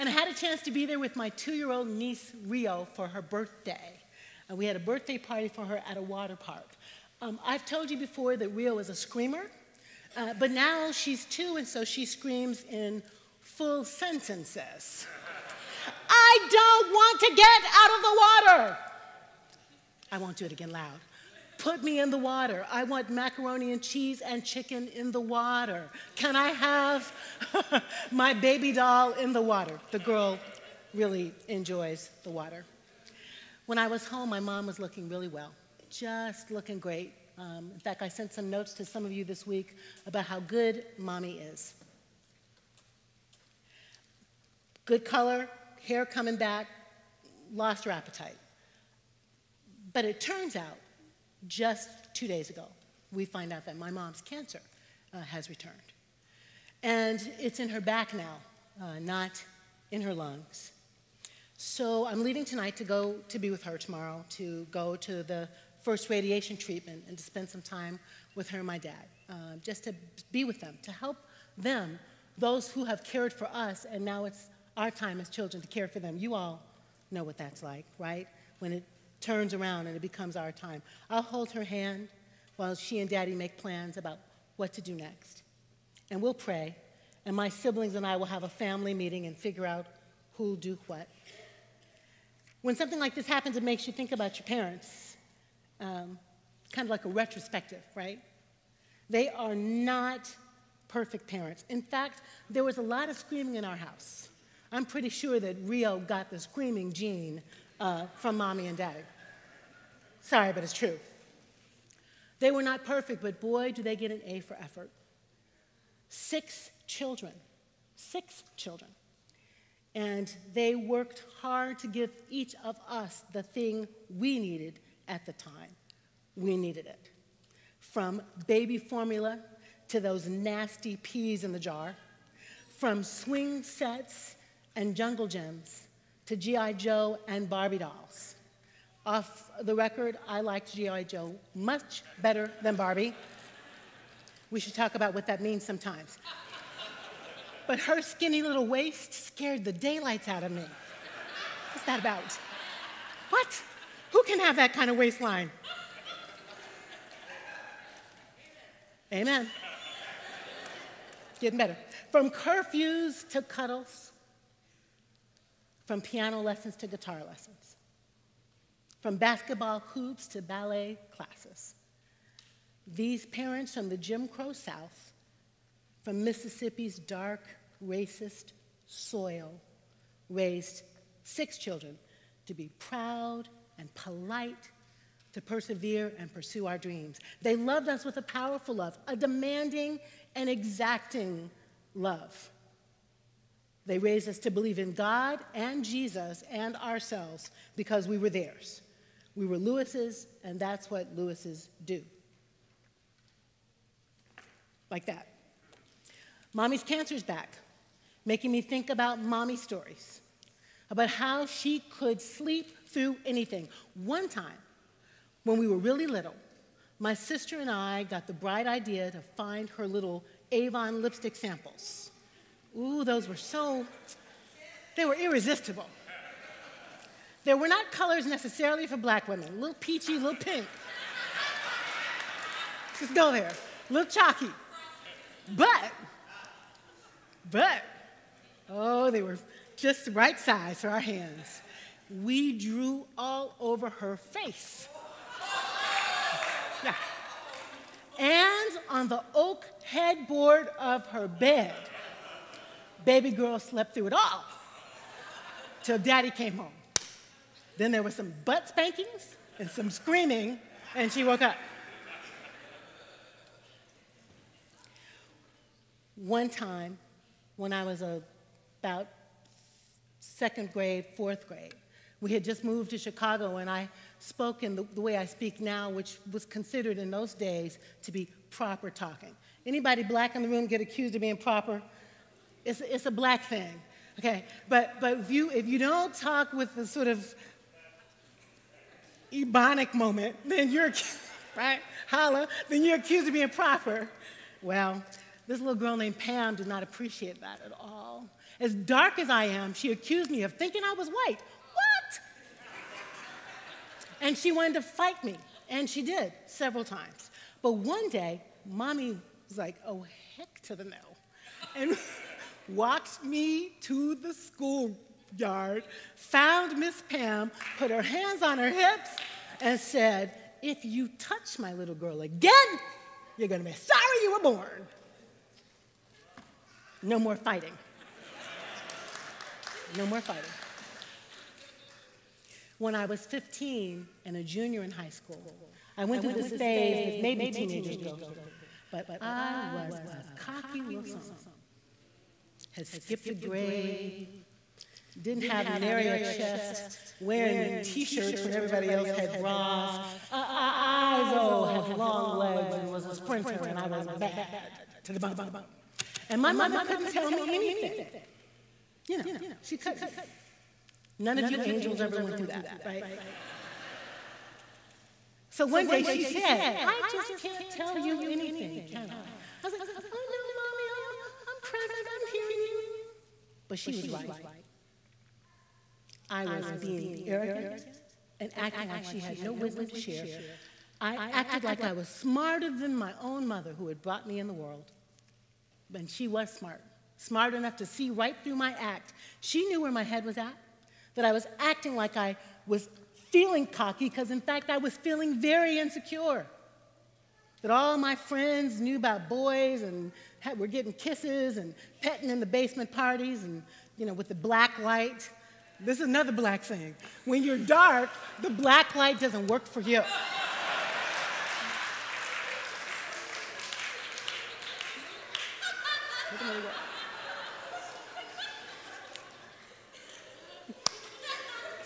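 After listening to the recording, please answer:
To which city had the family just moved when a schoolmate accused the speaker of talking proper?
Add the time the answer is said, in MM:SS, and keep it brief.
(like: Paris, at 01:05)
Chicago, at 04:32.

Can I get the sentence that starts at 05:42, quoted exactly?
Had skipped a grade, didn't have nary a chest, wearing t shirts when everybody else had bras.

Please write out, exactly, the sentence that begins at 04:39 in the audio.
Anybody black in the room get accused of being proper?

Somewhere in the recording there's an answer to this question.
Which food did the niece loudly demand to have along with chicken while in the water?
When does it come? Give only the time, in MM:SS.
00:23.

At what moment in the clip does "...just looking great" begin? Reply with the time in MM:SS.
00:35.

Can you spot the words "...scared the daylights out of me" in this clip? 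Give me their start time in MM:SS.
02:29.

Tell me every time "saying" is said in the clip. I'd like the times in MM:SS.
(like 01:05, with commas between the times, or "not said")
not said.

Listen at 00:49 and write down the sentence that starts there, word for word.
But it turns out just two days ago, we find out that my mom's cancer uh, has returned.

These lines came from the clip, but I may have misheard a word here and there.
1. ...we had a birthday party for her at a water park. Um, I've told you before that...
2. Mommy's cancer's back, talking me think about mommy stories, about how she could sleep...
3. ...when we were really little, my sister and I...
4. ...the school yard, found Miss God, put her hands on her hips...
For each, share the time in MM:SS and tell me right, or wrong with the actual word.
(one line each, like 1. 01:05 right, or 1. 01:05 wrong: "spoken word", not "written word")
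1. 00:04 right
2. 03:26 wrong: "making", not "talking"
3. 03:35 right
4. 05:14 wrong: "Pam", not "God".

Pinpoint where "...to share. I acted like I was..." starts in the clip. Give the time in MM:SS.
06:19.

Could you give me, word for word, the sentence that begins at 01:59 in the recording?
And they worked hard to give each of us the thing we needed at the time.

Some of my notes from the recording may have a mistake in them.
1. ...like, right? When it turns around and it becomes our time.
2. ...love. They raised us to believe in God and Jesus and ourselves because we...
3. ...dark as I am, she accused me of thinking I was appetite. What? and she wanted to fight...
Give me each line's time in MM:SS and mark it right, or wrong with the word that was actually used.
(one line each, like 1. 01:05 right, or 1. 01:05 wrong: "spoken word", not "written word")
1. 01:17 right
2. 03:11 right
3. 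04:58 wrong: "white", not "appetite".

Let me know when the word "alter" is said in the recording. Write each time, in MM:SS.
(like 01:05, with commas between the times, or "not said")
not said.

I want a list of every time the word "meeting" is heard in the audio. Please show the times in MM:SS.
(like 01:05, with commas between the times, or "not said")
01:28.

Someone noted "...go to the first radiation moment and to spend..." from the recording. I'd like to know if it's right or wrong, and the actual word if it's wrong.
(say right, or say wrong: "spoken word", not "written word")
wrong: "treatment", not "moment".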